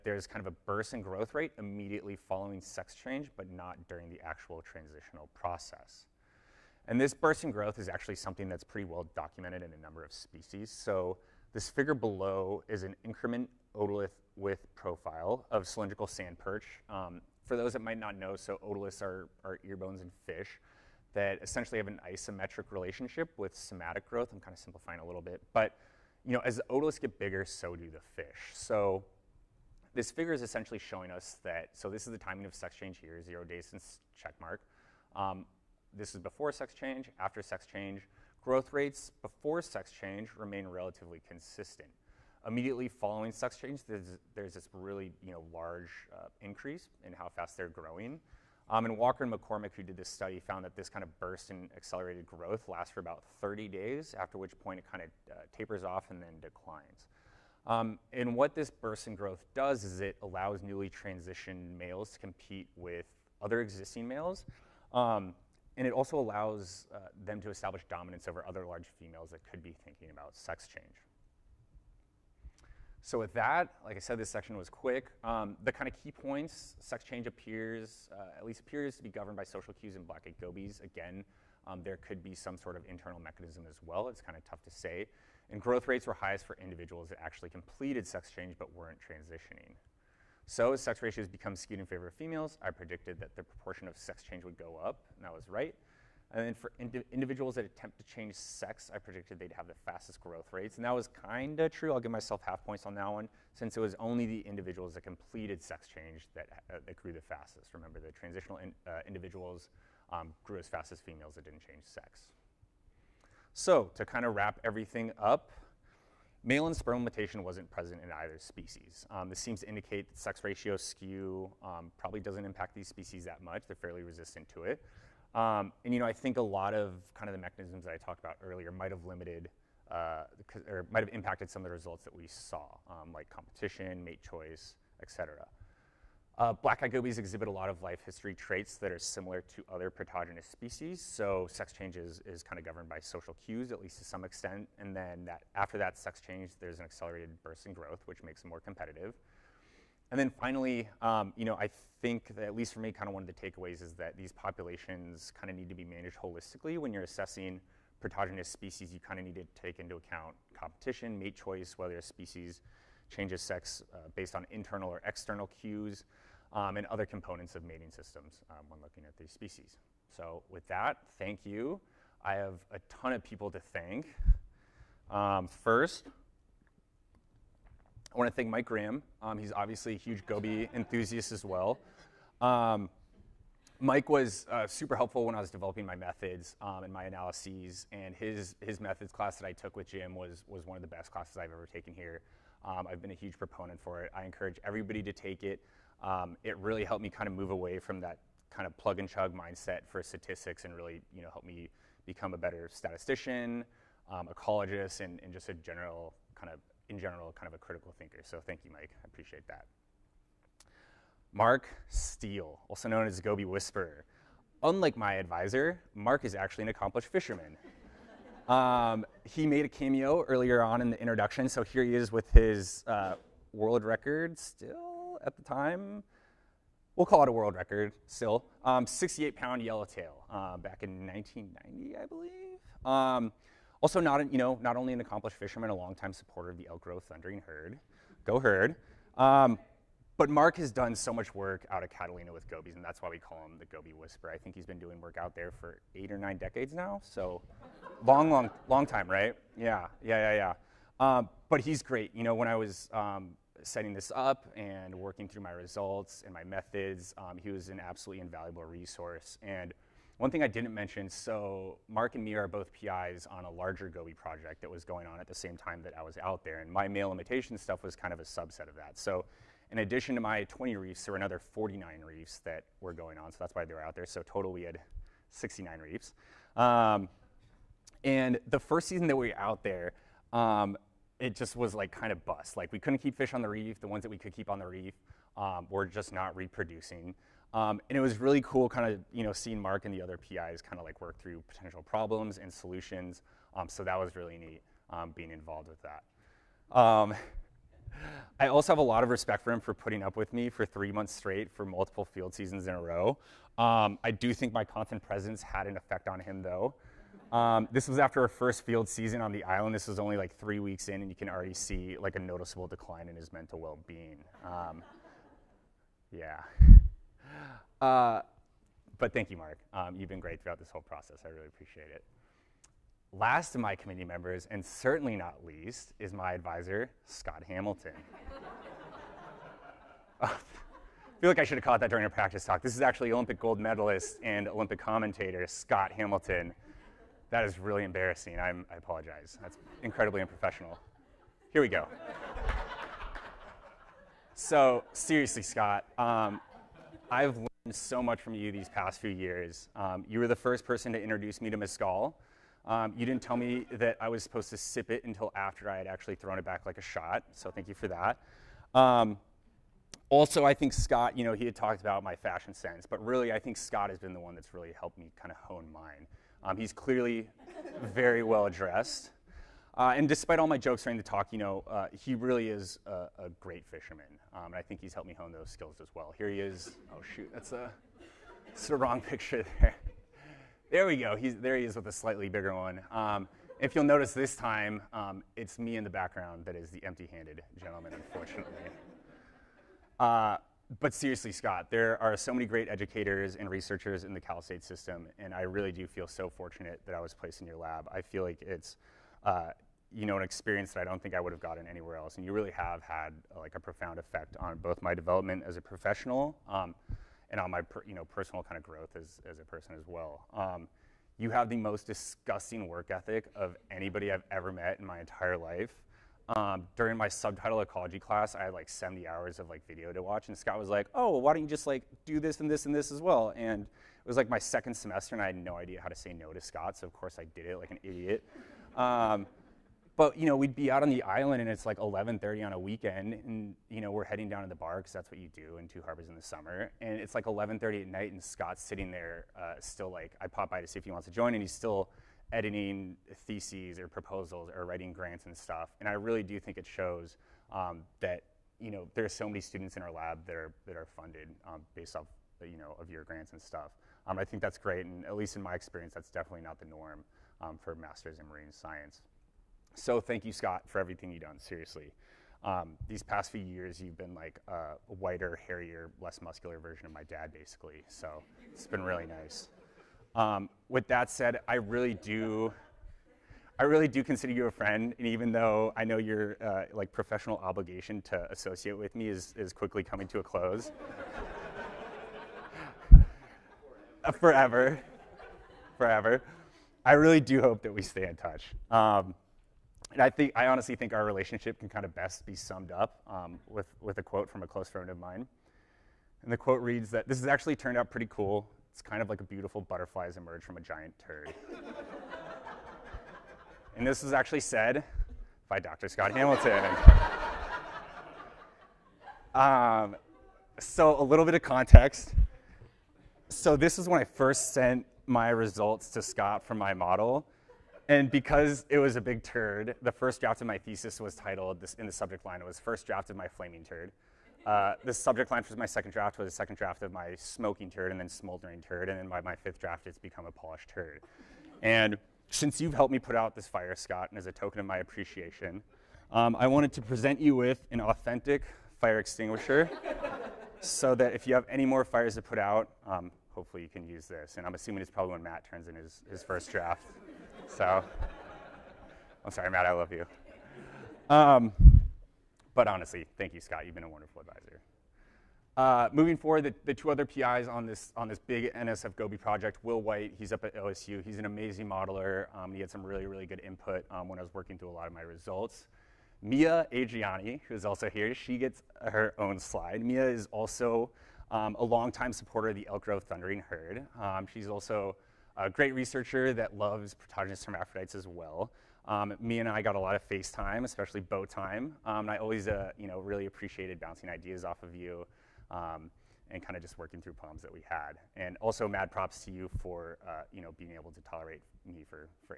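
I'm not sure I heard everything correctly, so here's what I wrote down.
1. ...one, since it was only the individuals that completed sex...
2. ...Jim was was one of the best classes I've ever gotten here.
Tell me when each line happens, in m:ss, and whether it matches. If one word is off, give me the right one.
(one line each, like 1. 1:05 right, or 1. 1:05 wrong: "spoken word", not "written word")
1. 1:43 right
2. 3:09 wrong: "taken", not "gotten".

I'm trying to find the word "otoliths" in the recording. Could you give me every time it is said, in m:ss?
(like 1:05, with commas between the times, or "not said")
0:13, 0:18, 0:26.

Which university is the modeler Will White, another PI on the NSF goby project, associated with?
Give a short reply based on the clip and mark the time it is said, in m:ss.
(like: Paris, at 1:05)
OSU, at 9:20.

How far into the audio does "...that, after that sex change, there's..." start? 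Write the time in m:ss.
2:25.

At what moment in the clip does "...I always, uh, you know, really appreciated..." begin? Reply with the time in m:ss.
9:42.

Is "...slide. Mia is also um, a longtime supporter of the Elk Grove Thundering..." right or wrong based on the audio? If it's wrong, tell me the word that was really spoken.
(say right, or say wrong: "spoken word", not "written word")
right.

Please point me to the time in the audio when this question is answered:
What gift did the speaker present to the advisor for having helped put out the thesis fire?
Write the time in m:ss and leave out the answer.
8:58.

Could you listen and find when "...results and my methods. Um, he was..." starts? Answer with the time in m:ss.
4:15.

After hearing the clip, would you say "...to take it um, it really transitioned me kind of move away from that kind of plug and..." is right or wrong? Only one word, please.
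wrong.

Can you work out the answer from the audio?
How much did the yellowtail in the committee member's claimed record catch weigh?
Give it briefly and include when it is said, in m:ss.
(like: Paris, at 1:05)
68 pounds, at 3:48.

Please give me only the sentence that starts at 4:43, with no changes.
The ones that we could keep on the reef um, were just not reproducing.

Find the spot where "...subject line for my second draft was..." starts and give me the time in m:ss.
8:44.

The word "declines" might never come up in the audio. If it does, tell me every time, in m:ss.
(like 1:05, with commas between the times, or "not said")
0:56, 5:12.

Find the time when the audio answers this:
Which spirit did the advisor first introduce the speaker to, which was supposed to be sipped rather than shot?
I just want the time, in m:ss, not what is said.
5:51.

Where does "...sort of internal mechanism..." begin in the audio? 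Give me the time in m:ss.
1:22.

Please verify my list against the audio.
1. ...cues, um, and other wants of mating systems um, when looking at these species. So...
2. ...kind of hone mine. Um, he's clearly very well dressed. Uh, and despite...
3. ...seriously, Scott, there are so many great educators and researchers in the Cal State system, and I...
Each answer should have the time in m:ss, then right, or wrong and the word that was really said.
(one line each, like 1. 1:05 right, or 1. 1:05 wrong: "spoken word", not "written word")
1. 2:45 wrong: "components", not "wants"
2. 6:05 right
3. 6:30 right.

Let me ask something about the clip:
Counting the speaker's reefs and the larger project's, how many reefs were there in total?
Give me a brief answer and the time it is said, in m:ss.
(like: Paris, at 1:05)
69, at 4:35.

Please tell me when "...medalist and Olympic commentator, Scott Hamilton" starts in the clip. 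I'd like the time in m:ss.
5:33.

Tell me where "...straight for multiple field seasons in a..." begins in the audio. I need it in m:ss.
5:01.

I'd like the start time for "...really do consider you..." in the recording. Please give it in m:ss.
7:53.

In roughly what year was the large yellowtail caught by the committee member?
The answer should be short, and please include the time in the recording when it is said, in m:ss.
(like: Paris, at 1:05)
1990, at 3:51.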